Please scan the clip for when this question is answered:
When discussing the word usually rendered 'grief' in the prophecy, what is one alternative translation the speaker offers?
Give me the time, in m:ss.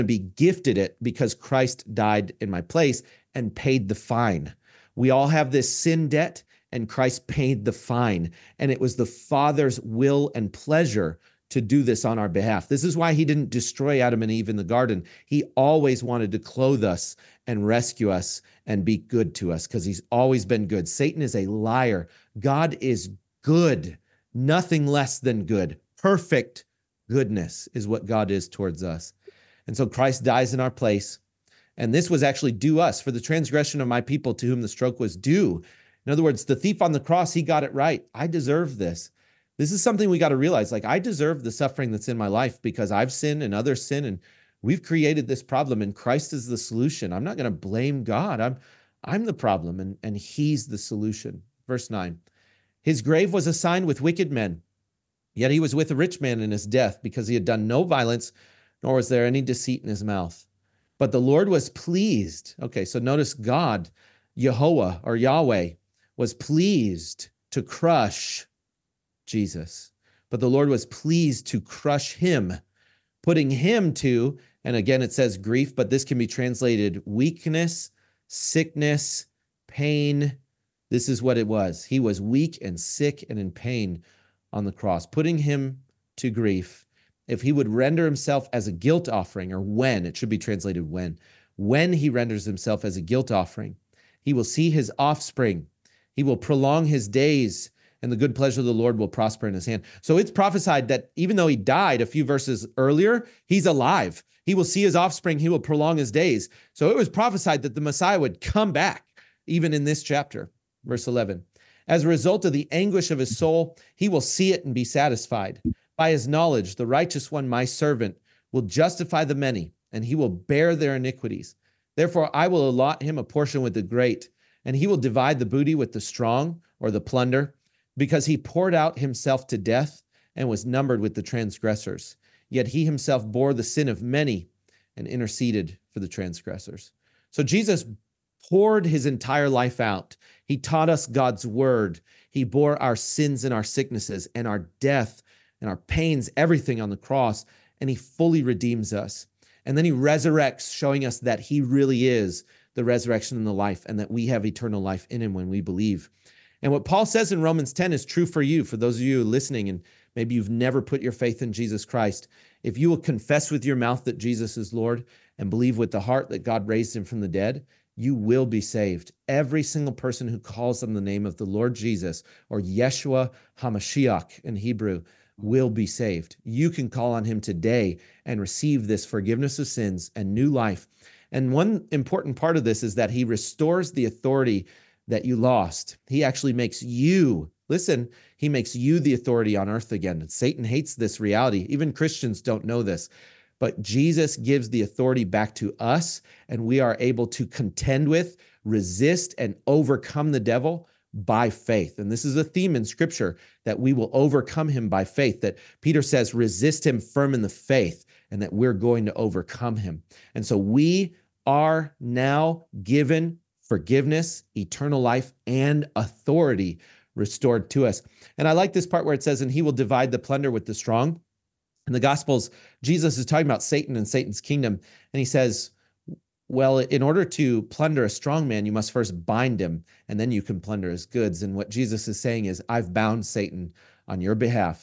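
1:17.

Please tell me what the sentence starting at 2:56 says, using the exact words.
You can call on him today and receive this forgiveness of sins and new life.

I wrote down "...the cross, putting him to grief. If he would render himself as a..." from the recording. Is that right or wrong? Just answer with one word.
right.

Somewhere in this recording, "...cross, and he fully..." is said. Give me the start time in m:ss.
2:26.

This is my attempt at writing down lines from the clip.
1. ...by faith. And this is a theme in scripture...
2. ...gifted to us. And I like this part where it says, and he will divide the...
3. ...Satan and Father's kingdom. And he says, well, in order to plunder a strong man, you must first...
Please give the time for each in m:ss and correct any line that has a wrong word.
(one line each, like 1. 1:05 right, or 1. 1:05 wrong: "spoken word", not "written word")
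1. 3:21 right
2. 3:37 wrong: "restored", not "gifted"
3. 3:43 wrong: "Satan", not "Father".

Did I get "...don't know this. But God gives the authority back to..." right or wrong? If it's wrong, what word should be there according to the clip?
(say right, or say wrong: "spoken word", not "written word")
wrong: "Jesus", not "God".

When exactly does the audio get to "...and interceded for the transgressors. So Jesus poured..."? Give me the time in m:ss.
2:14.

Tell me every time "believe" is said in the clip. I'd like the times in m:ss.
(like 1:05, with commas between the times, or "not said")
2:35, 2:45.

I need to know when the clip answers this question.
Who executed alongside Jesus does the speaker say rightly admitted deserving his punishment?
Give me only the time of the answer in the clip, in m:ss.
0:36.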